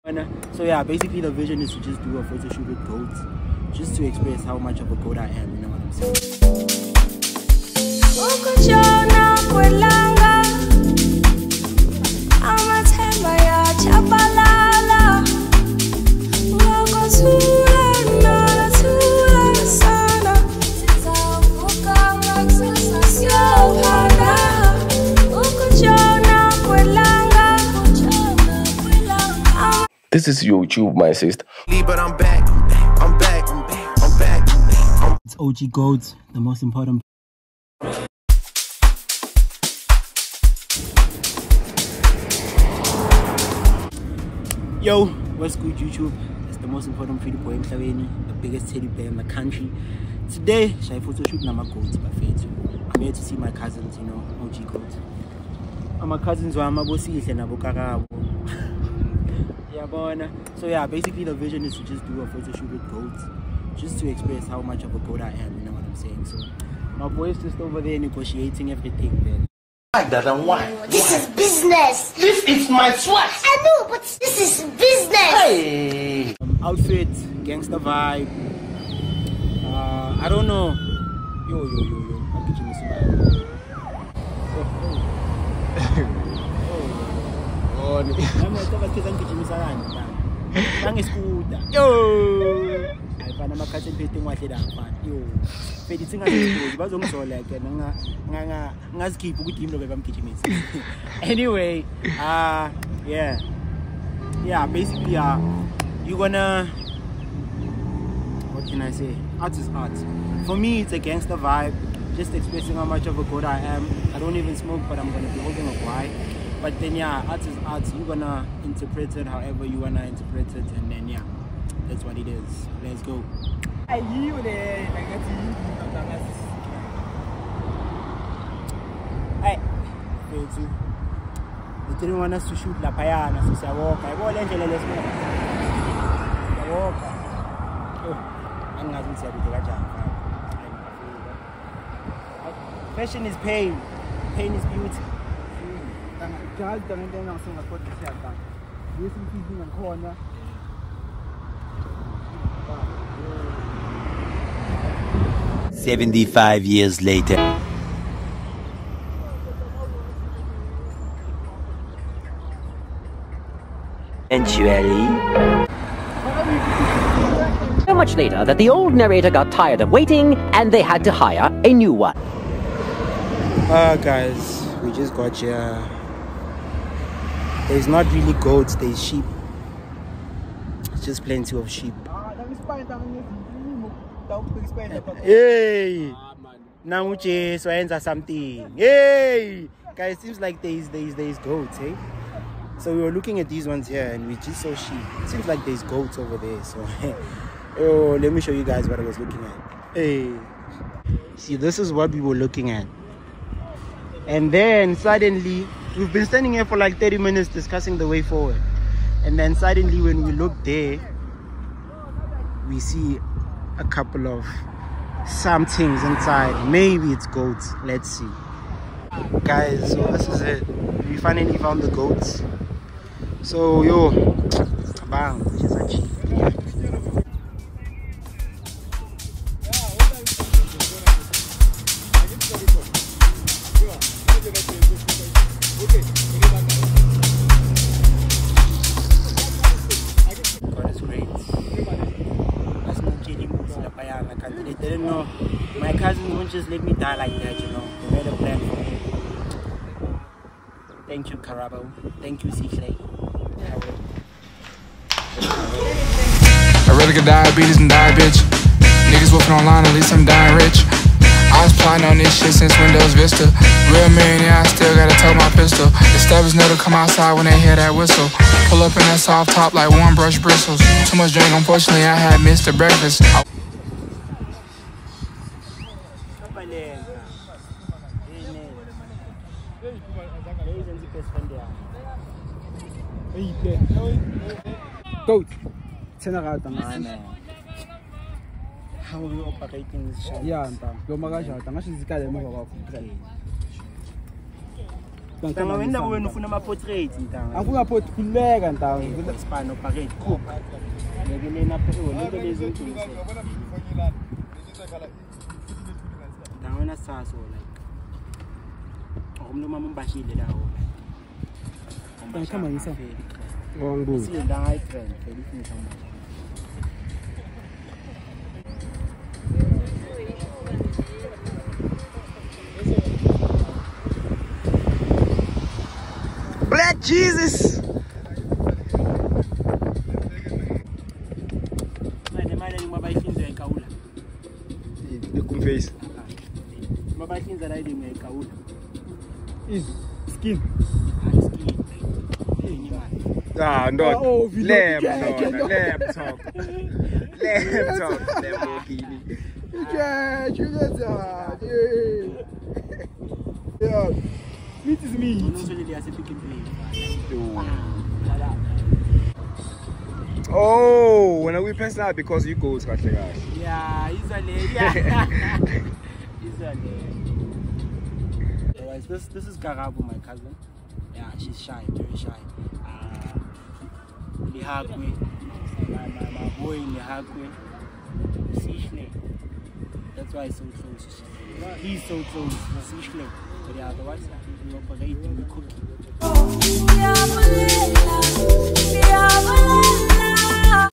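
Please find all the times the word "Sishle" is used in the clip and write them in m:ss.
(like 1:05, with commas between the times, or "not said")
6:18, 6:22.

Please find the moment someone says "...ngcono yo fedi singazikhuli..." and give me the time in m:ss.
1:33.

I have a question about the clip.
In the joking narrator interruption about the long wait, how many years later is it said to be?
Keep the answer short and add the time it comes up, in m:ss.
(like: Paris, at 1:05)
75, at 2:35.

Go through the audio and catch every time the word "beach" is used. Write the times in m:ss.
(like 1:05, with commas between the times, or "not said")
not said.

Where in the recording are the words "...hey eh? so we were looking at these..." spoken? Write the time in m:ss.
3:11.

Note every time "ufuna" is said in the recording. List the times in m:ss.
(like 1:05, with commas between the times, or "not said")
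4:56.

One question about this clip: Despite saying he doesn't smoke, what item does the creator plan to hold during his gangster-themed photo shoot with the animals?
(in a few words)
wine.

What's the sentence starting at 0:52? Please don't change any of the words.
I'm here to see my cousins, you know, OG Goats.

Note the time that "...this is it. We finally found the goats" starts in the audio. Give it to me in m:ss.
3:40.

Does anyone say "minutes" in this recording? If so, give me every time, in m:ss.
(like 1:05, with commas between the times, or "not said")
3:27.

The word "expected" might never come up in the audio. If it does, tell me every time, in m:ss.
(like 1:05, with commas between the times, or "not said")
not said.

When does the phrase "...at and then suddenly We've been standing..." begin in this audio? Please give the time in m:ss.
3:22.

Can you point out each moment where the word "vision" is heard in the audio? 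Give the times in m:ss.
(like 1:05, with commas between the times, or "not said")
0:01, 1:01.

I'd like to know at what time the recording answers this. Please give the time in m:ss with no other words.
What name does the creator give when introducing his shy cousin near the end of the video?
6:09.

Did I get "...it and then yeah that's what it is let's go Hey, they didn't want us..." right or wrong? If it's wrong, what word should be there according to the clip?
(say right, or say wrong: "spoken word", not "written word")
right.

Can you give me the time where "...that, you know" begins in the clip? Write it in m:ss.
4:07.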